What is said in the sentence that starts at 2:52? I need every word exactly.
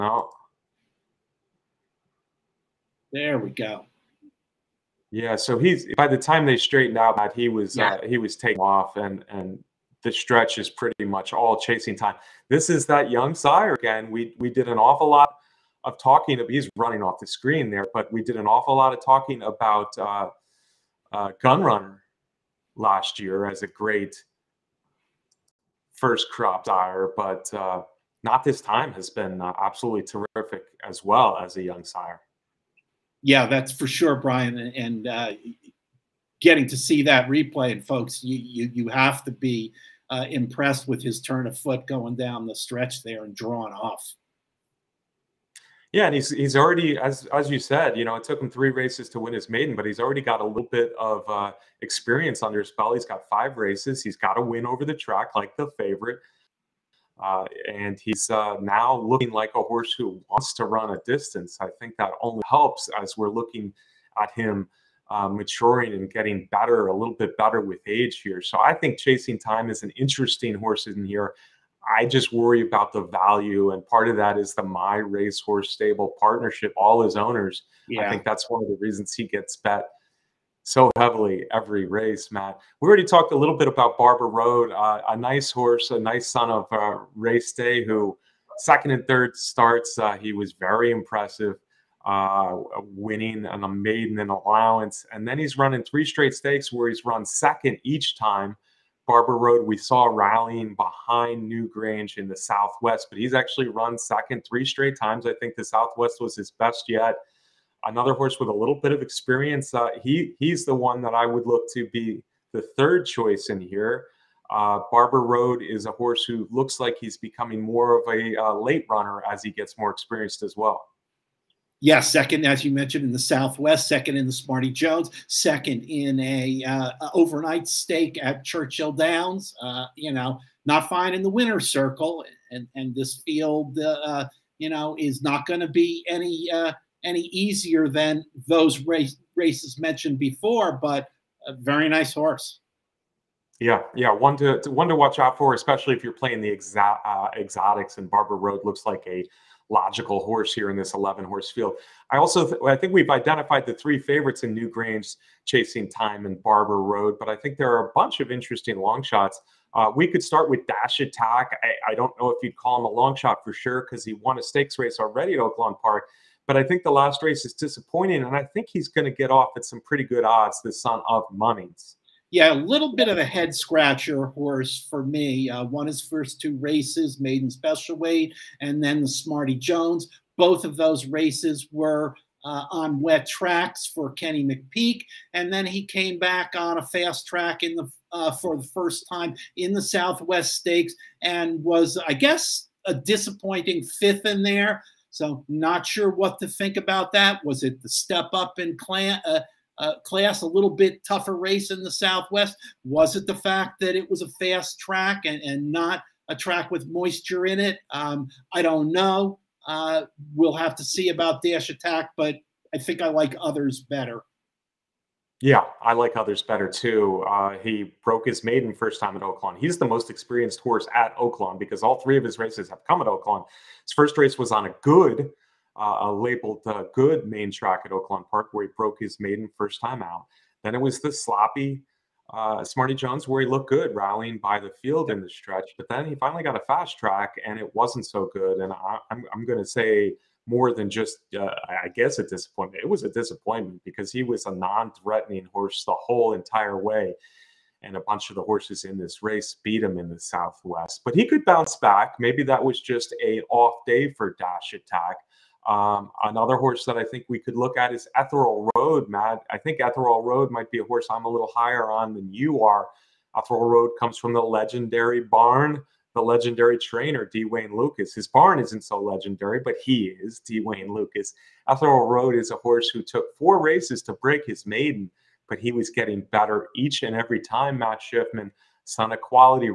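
Yeah, a little bit of a head scratcher horse for me.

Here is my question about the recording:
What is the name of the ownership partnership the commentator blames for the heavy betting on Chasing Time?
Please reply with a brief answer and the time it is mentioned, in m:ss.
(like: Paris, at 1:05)
My Racehorse Stable, at 1:14.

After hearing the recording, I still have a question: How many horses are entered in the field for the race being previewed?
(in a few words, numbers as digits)
11.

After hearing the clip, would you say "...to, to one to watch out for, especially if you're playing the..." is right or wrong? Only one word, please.
right.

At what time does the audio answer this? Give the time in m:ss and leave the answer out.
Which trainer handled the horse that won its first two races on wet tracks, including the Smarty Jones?
3:04.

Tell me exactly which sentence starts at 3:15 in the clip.
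So not sure what to think about that.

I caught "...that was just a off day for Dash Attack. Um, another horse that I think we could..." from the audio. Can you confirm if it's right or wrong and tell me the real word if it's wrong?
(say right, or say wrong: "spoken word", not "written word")
right.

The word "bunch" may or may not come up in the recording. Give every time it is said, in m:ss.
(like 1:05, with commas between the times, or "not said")
2:37, 4:08.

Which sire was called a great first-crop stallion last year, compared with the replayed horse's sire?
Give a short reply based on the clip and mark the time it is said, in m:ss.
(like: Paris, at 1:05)
Gun Runner, at 0:21.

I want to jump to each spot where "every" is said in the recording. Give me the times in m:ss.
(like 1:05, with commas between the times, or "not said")
1:21, 4:37.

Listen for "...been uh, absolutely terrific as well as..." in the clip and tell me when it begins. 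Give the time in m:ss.
0:29.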